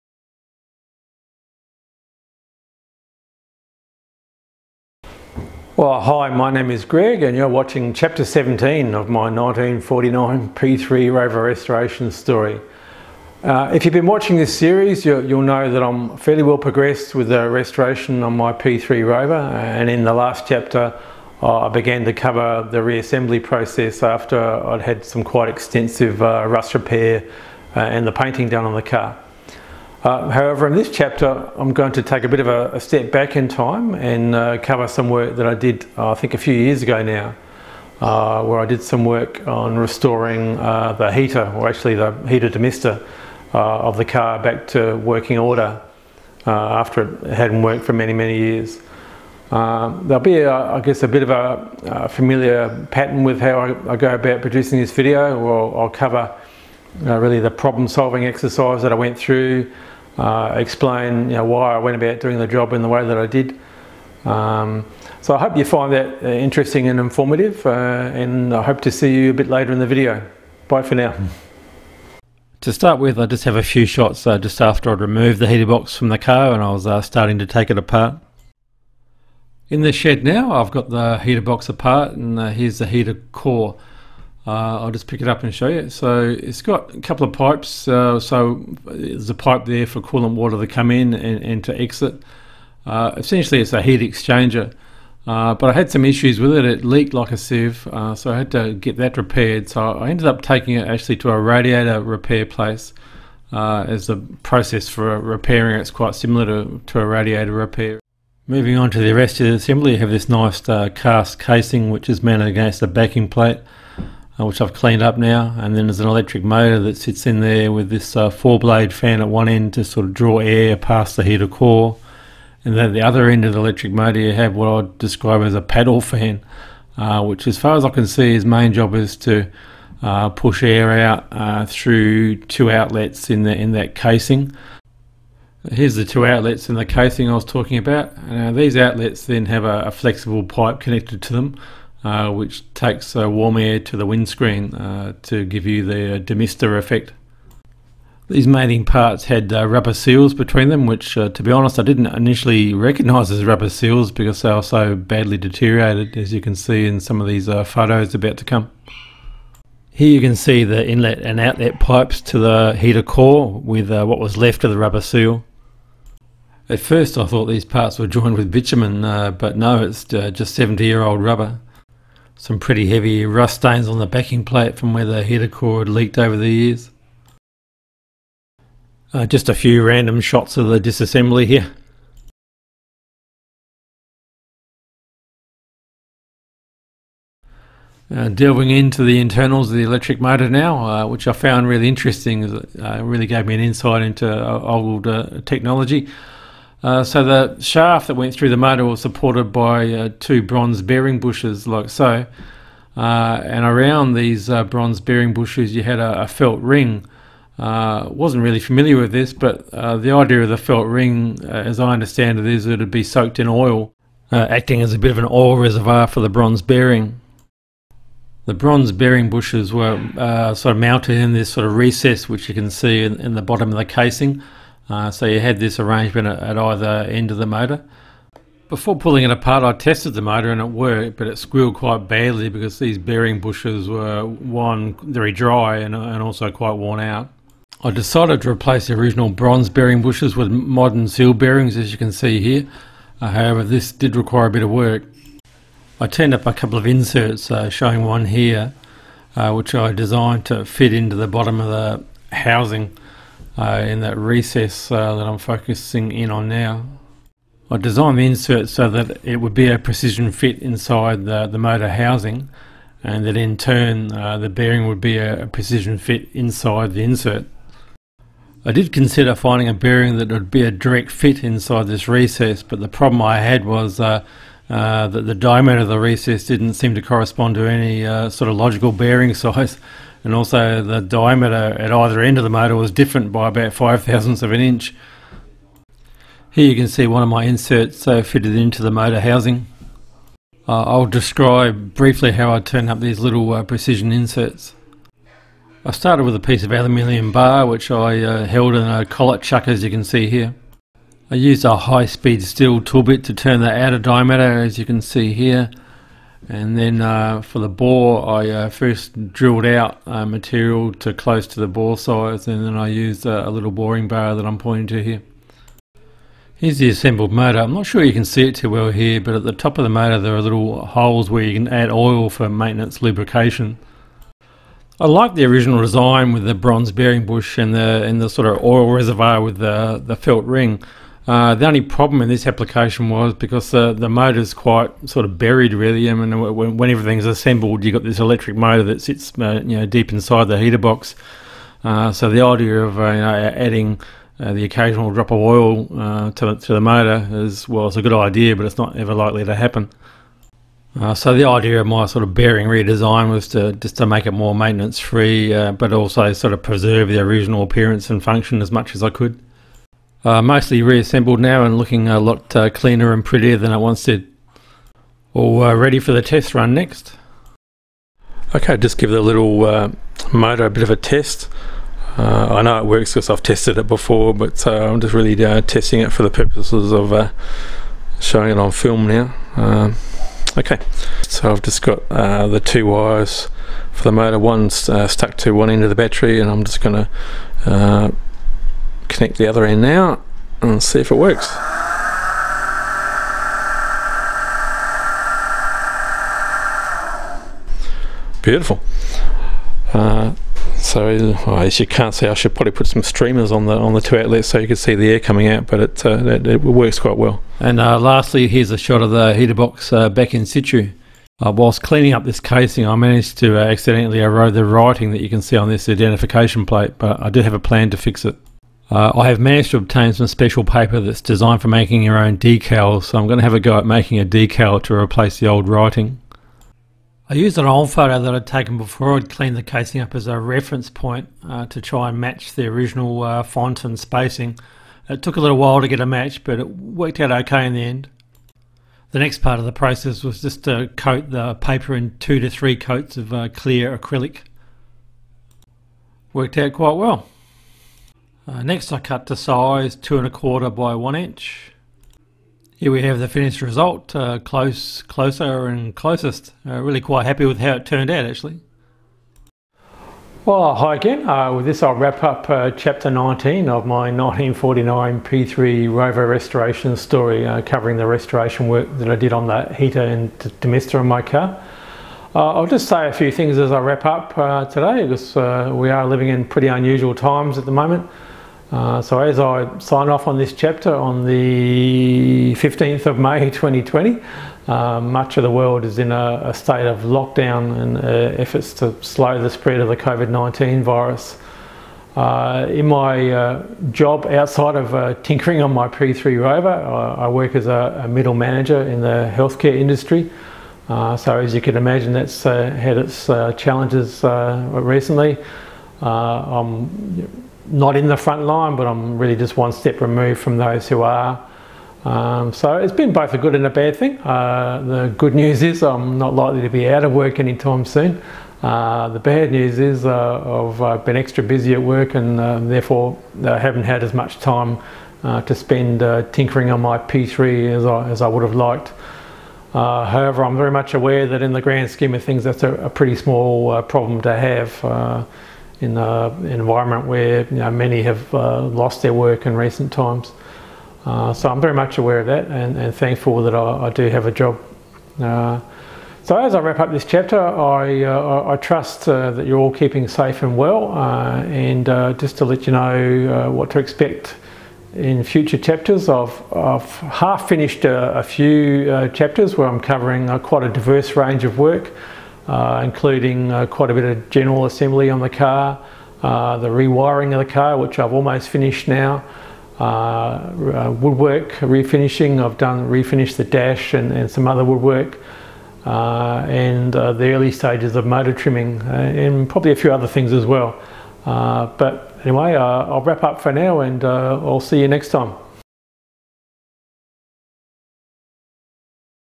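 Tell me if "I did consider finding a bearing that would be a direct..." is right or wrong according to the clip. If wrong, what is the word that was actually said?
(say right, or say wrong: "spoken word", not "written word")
right.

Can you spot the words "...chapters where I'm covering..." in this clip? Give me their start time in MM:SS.
09:19.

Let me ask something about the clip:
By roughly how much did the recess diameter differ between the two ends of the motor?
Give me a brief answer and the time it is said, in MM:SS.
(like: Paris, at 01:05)
5 thousandths of an inch, at 04:43.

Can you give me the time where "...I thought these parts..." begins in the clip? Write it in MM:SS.
02:47.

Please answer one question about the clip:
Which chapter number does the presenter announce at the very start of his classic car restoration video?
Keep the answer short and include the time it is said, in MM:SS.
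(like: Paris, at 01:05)
17, at 00:07.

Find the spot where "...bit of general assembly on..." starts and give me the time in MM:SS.
09:23.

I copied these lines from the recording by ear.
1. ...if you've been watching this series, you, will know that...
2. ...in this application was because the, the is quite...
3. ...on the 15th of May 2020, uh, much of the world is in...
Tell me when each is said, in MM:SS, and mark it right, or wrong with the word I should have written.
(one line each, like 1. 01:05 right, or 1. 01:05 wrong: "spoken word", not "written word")
1. 00:13 right
2. 05:32 right
3. 08:00 right.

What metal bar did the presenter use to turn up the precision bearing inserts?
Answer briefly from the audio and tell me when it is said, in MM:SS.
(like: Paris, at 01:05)
Aluminium, at 04:56.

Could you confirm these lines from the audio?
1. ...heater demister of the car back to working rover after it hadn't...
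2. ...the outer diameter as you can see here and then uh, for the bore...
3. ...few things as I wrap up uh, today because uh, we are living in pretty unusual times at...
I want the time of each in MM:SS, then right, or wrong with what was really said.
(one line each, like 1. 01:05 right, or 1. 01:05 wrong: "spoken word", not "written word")
1. 00:42 wrong: "order", not "rover"
2. 05:03 right
3. 07:53 right.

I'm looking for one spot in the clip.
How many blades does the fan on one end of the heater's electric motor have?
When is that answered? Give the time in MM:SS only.
01:58.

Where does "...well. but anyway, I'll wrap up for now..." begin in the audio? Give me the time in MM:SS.
09:40.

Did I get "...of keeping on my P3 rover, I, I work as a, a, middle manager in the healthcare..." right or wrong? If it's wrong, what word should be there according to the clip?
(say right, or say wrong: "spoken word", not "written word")
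wrong: "tinkering", not "keeping".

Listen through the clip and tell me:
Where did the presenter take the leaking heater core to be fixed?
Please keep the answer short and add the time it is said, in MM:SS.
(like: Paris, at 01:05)
A radiator repair place, at 01:41.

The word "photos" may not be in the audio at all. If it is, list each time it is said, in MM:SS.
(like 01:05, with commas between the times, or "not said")
02:37, 07:07.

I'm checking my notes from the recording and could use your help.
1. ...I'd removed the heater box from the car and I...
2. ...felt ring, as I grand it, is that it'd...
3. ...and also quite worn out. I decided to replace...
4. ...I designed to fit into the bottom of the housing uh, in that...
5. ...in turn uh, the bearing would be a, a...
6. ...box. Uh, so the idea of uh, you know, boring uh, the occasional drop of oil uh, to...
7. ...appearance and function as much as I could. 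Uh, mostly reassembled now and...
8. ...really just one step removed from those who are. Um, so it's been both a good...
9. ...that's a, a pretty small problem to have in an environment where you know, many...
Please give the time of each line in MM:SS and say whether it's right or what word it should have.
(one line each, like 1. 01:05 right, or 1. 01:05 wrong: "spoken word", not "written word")
1. 01:14 right
2. 03:30 wrong: "understand", not "grand"
3. 03:55 right
4. 04:09 right
5. 04:23 right
6. 05:40 wrong: "adding", not "boring"
7. 05:57 right
8. 08:29 right
9. 08:52 right.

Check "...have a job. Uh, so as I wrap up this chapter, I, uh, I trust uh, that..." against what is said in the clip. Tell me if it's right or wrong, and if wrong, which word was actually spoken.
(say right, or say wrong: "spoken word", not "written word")
right.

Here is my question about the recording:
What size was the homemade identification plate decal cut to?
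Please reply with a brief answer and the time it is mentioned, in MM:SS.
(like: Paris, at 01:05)
2 1/4 by 1 inch, at 07:29.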